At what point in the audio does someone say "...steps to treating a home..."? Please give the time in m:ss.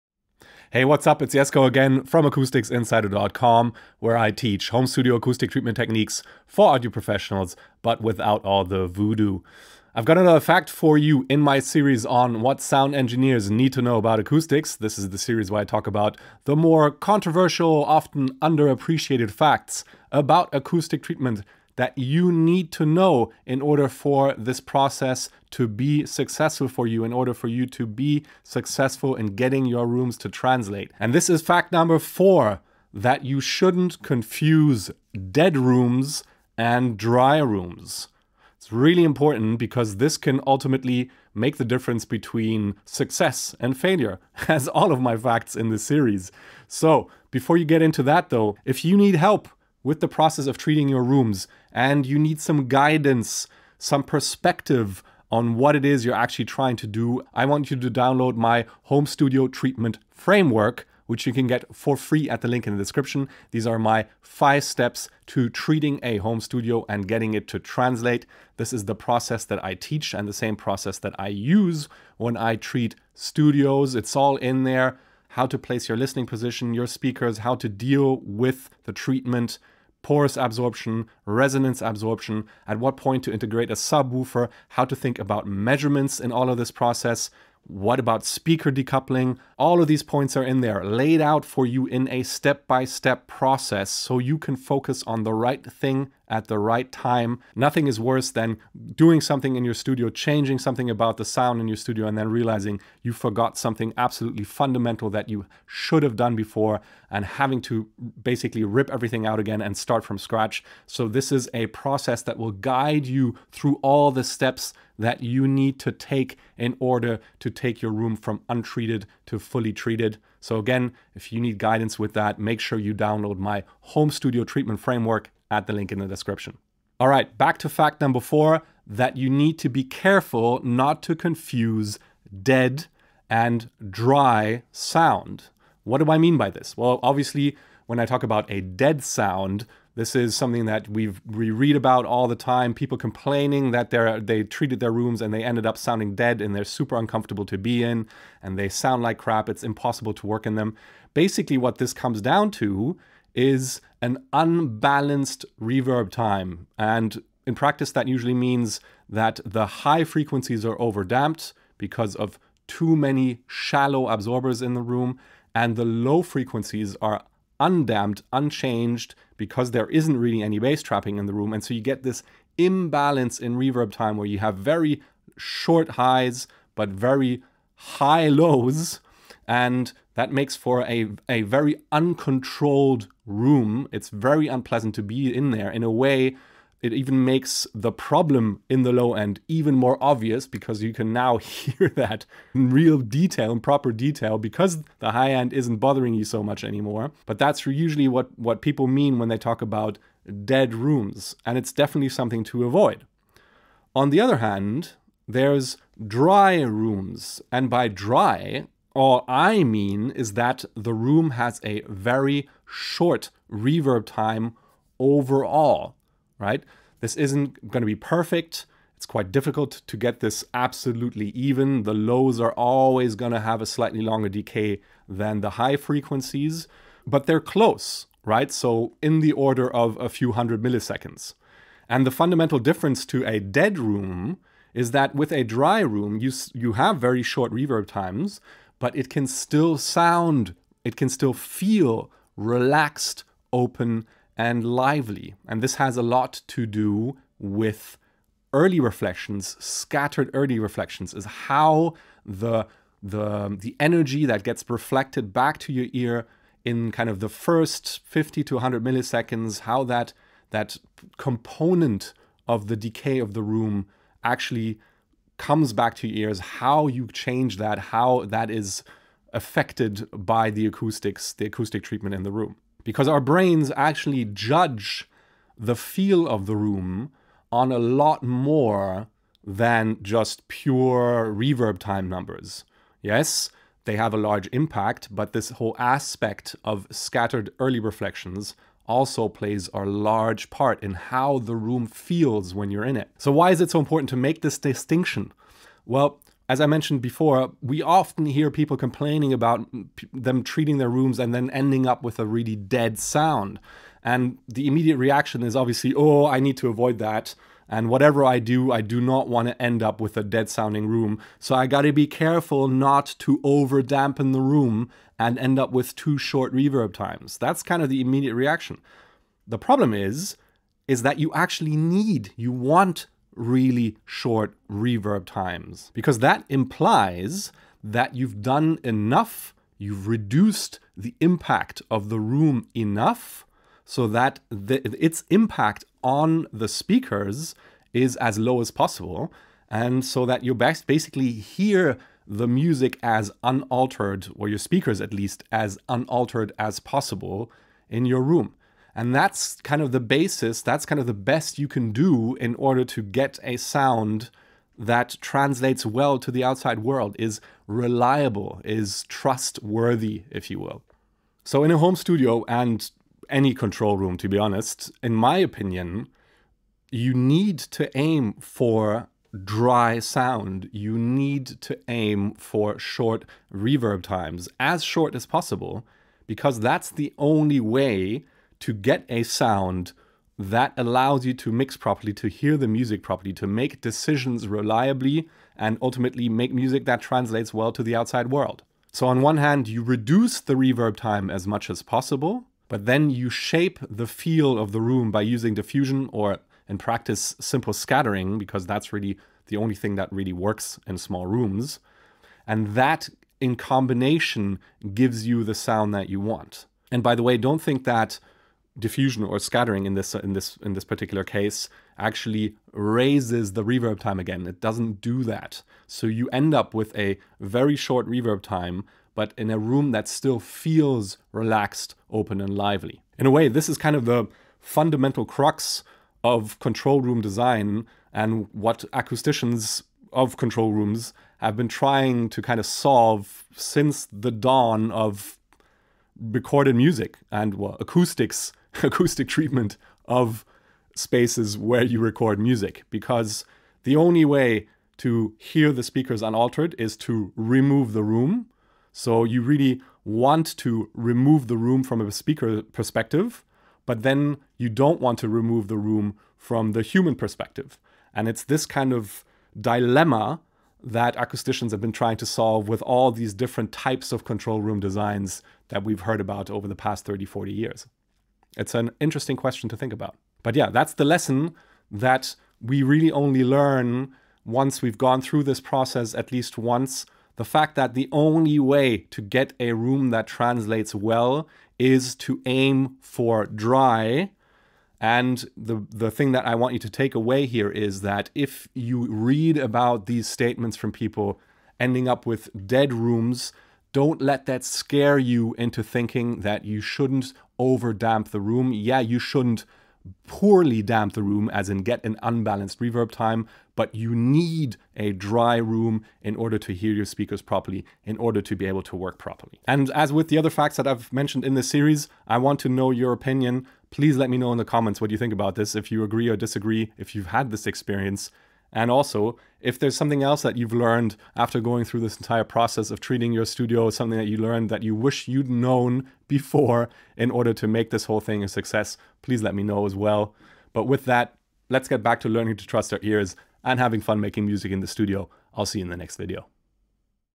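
1:04.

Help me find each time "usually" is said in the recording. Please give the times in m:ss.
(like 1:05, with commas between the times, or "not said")
2:38, 3:17.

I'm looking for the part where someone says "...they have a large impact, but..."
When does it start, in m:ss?
4:43.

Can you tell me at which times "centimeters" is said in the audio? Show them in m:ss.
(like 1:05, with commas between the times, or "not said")
not said.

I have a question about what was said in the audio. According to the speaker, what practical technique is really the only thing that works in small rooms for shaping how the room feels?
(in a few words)
simple scattering.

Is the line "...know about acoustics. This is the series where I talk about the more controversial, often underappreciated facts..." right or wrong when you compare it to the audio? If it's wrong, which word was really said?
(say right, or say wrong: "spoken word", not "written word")
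right.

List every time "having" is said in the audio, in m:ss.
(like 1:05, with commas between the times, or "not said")
1:47, 8:53.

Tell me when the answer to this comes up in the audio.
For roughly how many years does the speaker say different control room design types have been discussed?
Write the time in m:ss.
7:47.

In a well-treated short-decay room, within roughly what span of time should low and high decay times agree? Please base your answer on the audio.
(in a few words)
a few hundred milliseconds.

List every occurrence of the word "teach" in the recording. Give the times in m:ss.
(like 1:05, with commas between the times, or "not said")
0:04, 1:09.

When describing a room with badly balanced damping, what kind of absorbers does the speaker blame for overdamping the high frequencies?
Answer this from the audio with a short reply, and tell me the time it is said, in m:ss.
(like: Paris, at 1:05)
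shallow absorbers, at 2:43.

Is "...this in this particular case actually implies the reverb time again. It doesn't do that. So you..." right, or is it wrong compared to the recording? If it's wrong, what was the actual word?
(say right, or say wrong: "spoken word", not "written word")
wrong: "raises", not "implies".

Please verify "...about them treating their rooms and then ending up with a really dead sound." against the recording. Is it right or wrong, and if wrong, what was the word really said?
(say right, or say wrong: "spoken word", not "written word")
right.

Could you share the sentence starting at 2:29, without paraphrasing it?
It's impossible to work in them.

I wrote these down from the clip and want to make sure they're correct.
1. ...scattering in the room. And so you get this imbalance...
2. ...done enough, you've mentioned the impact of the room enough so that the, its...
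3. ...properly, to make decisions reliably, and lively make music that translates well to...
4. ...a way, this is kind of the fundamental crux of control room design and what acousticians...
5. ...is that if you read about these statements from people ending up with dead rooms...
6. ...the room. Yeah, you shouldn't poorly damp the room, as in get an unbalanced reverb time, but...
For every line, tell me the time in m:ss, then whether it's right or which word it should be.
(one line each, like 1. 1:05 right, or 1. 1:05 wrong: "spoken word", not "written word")
1. 2:50 wrong: "trapping", not "scattering"
2. 5:28 wrong: "reduced", not "mentioned"
3. 6:23 wrong: "ultimately", not "lively"
4. 7:03 right
5. 8:07 right
6. 8:18 right.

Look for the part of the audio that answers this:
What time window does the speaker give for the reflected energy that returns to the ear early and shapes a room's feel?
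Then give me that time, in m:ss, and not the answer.
4:18.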